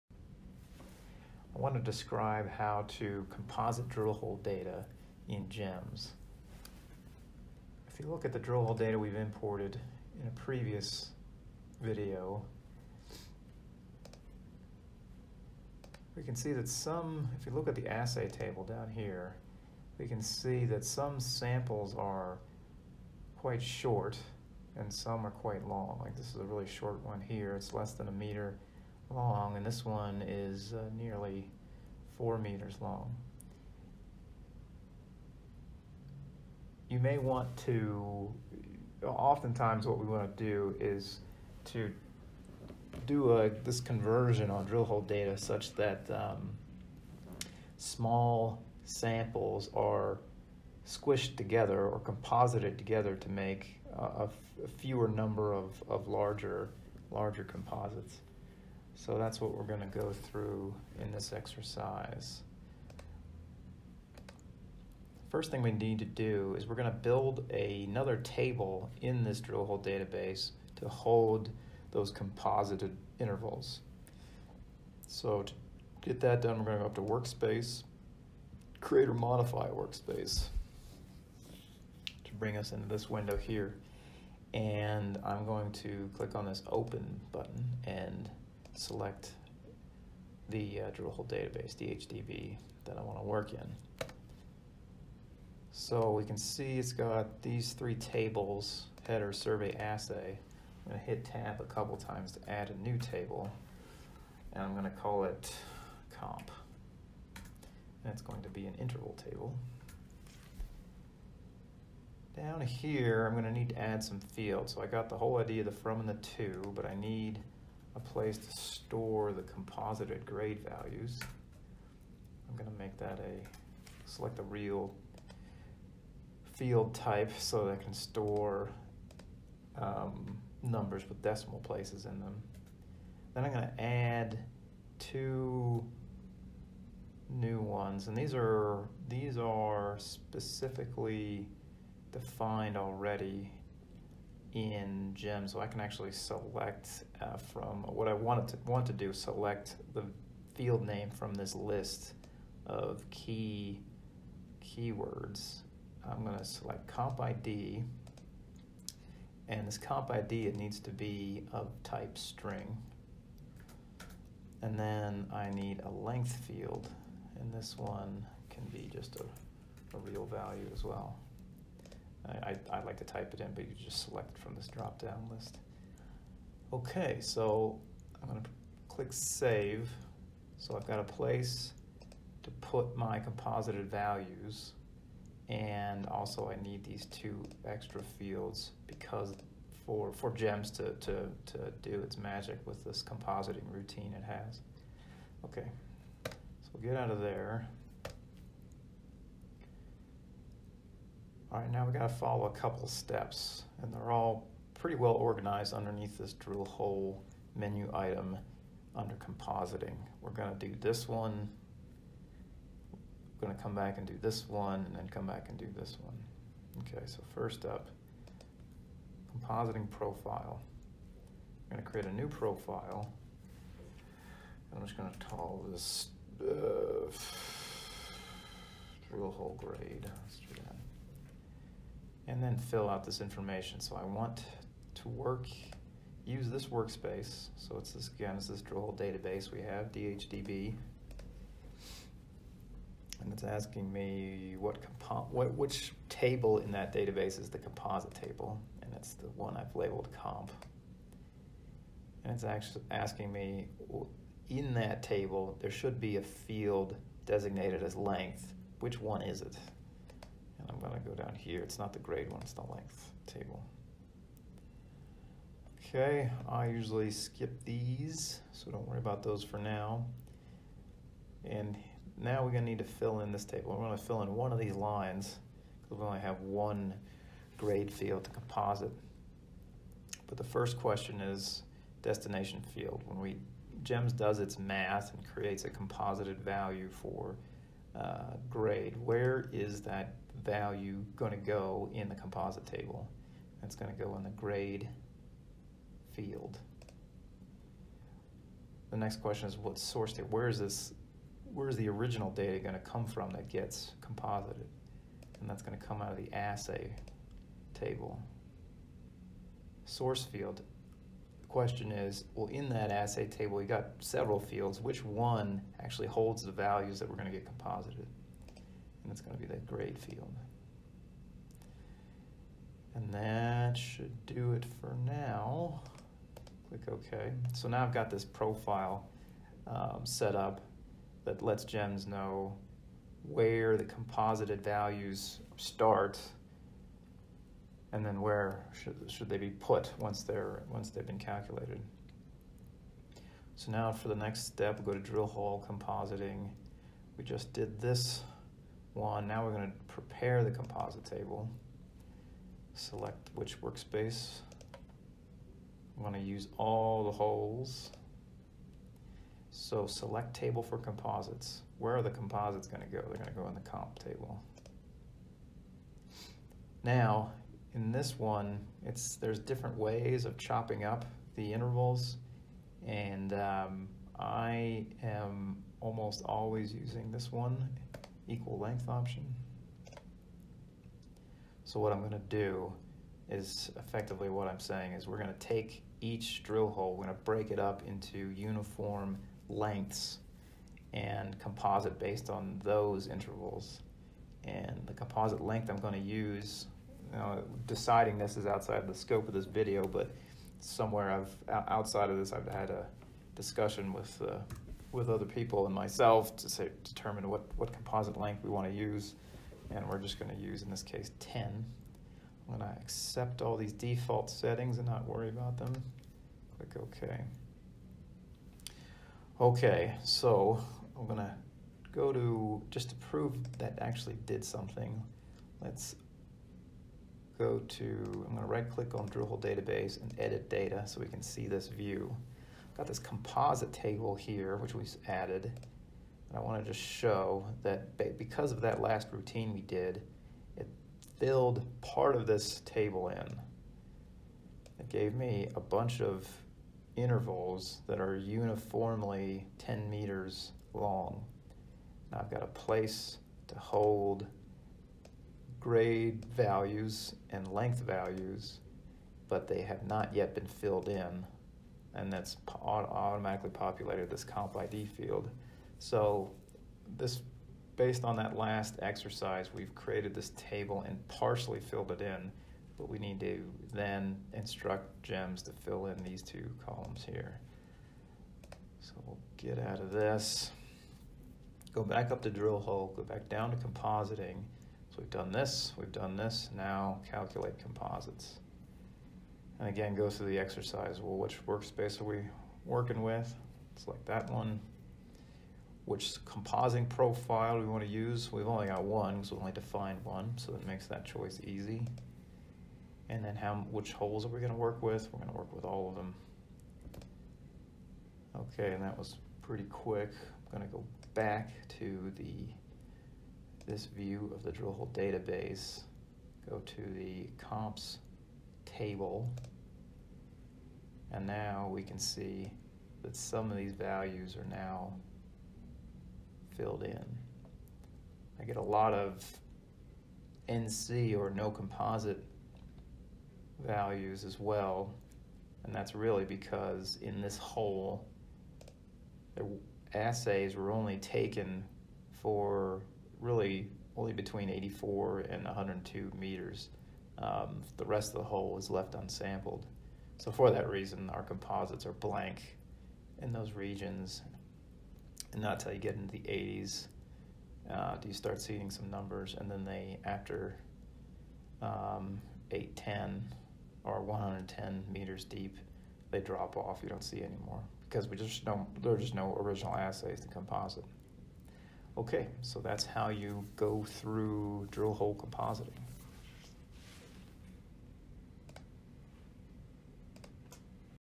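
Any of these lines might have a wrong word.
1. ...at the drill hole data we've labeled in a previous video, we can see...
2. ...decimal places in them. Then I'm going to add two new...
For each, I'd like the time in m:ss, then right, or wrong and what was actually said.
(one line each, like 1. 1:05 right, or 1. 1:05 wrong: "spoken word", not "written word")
1. 0:08 wrong: "imported", not "labeled"
2. 2:11 right.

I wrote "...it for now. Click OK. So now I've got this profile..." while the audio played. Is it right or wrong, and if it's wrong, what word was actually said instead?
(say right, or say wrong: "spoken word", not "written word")
right.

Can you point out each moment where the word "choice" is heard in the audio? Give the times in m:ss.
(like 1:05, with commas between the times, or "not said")
8:21.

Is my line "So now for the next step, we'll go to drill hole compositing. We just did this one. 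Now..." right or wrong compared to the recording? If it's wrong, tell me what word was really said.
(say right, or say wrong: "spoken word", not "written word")
right.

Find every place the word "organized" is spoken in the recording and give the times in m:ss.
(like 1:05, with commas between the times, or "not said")
3:25.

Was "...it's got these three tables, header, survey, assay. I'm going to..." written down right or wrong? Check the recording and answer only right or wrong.
right.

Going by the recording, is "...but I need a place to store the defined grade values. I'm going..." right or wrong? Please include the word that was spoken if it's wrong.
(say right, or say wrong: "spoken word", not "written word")
wrong: "composited", not "defined".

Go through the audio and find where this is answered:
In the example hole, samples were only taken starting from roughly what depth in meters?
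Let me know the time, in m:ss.
9:04.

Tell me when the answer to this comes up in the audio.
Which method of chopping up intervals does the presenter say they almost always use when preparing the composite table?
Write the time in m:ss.
6:18.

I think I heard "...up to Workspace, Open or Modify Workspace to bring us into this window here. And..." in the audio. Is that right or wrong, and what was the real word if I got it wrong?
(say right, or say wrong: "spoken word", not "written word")
wrong: "Create", not "Open".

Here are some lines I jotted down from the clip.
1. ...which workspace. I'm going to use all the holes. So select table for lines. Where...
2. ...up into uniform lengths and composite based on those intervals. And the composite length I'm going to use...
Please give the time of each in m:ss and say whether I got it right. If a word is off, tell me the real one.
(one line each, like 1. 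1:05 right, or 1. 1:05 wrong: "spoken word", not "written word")
1. 5:53 wrong: "composites", not "lines"
2. 6:27 right.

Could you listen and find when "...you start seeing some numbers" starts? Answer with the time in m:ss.
9:18.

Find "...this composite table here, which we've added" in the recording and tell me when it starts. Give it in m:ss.
7:12.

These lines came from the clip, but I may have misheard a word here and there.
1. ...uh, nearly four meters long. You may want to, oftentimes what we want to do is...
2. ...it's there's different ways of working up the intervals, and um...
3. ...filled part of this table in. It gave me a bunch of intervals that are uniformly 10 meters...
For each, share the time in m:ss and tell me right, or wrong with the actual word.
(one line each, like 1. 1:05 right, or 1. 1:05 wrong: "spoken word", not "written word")
1. 0:30 right
2. 6:08 wrong: "chopping", not "working"
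3. 7:21 right.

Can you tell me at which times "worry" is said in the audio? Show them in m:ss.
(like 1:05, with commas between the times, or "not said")
4:28, 6:55.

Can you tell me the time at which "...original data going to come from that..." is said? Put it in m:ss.
5:01.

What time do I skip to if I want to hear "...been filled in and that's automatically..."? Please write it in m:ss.
7:40.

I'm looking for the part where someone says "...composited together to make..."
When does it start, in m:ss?
0:52.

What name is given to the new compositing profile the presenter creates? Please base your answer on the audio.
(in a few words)
drill hole grade.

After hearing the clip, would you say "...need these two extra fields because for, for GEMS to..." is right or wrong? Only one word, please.
right.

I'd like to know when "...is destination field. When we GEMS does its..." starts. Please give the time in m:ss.
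4:41.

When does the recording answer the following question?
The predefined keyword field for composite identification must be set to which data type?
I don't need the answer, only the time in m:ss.
2:42.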